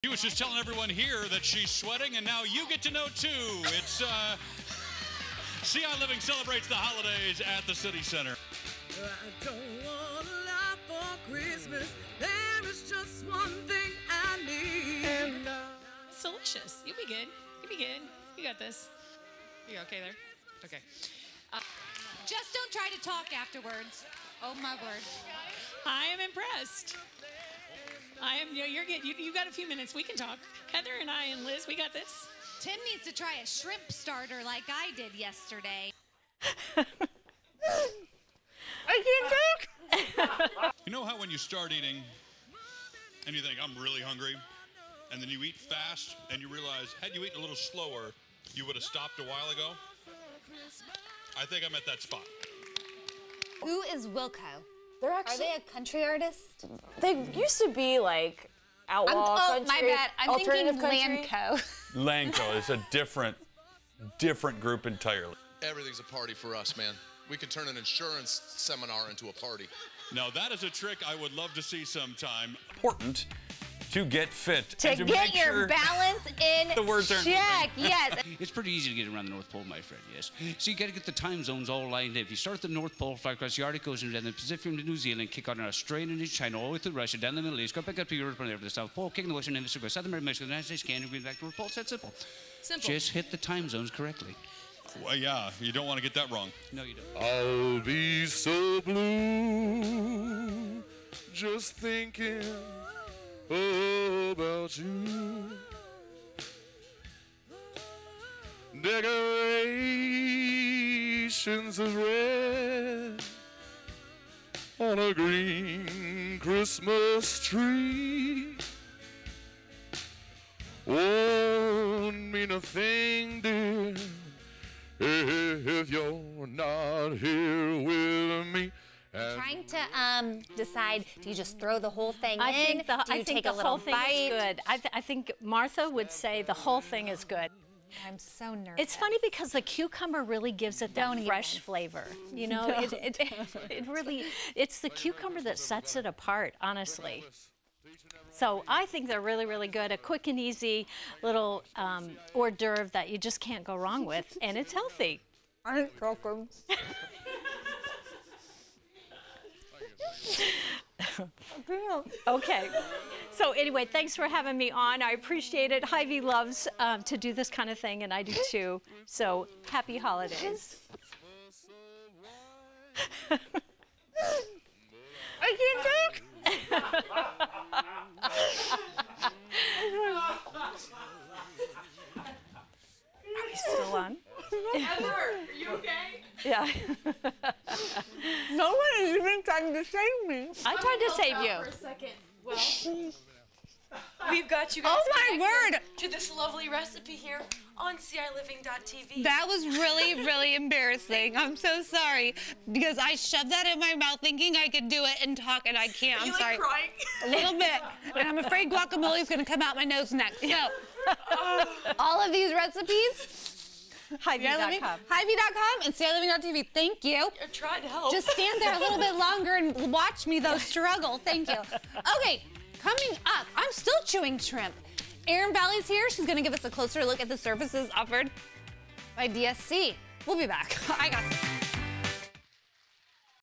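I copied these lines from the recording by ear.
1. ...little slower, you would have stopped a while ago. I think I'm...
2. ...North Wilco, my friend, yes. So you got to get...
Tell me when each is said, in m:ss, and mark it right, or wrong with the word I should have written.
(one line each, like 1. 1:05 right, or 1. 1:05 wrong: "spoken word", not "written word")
1. 0:47 right
2. 1:19 wrong: "Pole", not "Wilco".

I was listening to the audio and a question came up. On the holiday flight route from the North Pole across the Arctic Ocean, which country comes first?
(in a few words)
New Zealand.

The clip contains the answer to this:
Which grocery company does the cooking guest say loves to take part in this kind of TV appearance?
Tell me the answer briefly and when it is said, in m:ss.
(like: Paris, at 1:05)
Hy-Vee, at 2:45.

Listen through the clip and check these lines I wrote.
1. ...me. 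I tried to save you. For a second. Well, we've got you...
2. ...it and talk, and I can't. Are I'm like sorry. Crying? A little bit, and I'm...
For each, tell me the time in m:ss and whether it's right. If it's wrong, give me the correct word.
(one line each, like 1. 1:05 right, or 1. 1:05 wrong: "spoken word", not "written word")
1. 3:10 right
2. 3:25 right.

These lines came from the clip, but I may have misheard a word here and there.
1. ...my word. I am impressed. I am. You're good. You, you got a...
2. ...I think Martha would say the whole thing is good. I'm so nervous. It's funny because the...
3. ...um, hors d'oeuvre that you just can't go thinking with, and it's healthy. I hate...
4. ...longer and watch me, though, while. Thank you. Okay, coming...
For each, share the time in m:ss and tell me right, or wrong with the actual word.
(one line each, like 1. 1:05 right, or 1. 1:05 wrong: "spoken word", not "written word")
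1. 0:24 right
2. 2:14 right
3. 2:31 wrong: "wrong", not "thinking"
4. 3:39 wrong: "struggle", not "while".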